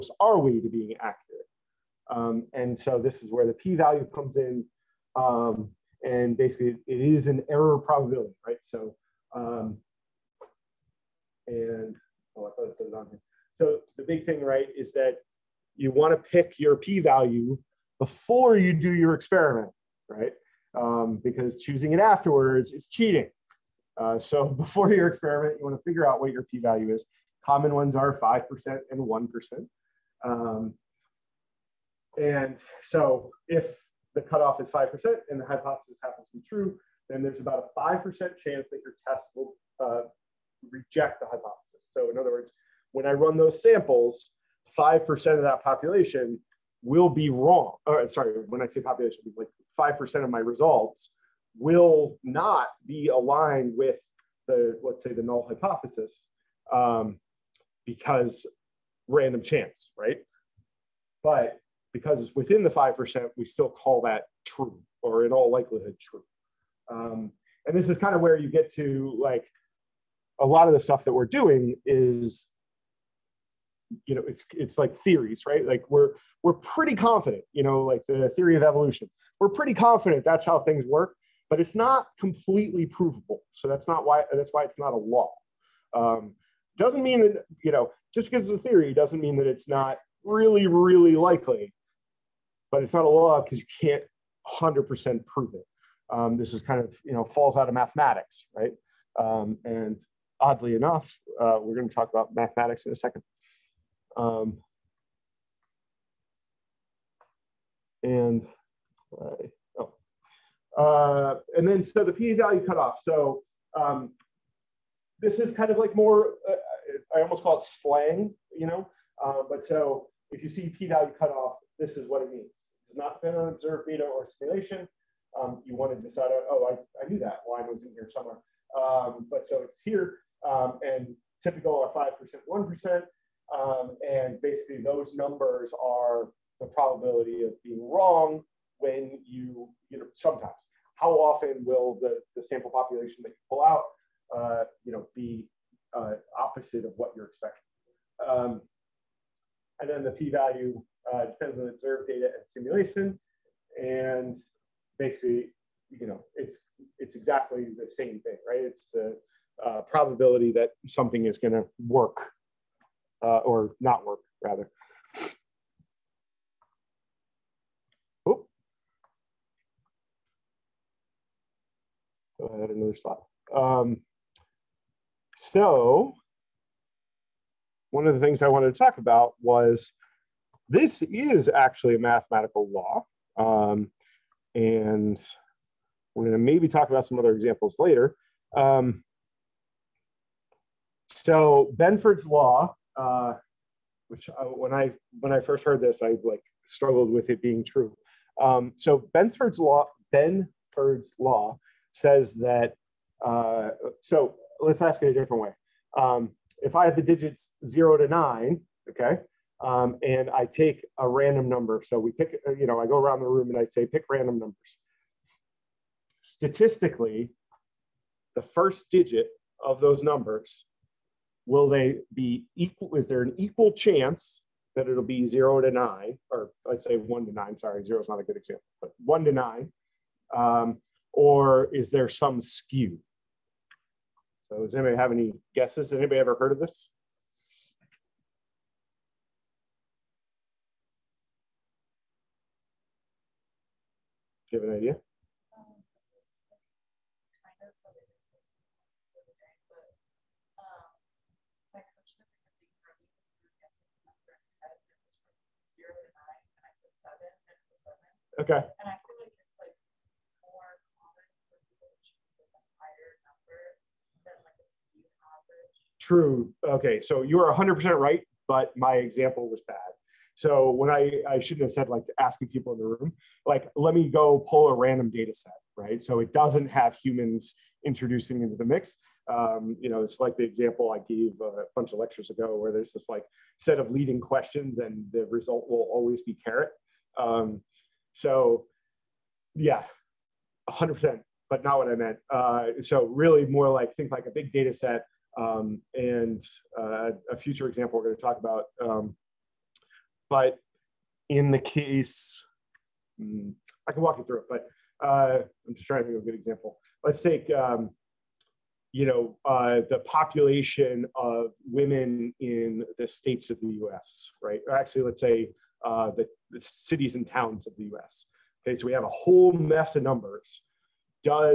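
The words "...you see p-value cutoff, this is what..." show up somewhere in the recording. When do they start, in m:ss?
2:00.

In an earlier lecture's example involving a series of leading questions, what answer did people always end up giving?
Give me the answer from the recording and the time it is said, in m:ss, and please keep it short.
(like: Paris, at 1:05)
carrot, at 4:46.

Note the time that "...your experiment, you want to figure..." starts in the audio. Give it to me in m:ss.
0:24.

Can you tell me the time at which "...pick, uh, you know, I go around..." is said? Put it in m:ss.
3:32.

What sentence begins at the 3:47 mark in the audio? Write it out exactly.
Sorry, zero is not a good example, but one to nine.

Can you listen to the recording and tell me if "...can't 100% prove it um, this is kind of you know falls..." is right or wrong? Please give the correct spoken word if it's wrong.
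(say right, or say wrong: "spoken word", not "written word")
right.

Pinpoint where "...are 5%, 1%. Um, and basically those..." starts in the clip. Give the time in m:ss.
2:11.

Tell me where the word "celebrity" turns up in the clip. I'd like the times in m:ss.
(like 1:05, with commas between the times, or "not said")
not said.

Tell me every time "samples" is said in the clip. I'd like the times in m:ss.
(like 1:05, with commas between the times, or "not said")
0:43, 2:22.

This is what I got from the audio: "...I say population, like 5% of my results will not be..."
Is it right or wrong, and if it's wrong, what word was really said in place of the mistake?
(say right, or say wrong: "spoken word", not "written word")
right.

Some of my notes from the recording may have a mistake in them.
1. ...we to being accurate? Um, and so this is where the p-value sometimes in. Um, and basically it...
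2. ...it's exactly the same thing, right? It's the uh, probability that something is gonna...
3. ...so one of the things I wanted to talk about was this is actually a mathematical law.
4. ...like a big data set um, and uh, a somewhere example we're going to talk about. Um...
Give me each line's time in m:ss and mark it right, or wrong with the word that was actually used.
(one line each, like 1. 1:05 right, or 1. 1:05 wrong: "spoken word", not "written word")
1. 0:00 wrong: "comes", not "sometimes"
2. 2:36 right
3. 2:55 right
4. 4:54 wrong: "future", not "somewhere".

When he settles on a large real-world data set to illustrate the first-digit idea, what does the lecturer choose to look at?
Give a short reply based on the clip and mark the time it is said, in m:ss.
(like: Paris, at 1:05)
cities and towns of the US, at 5:16.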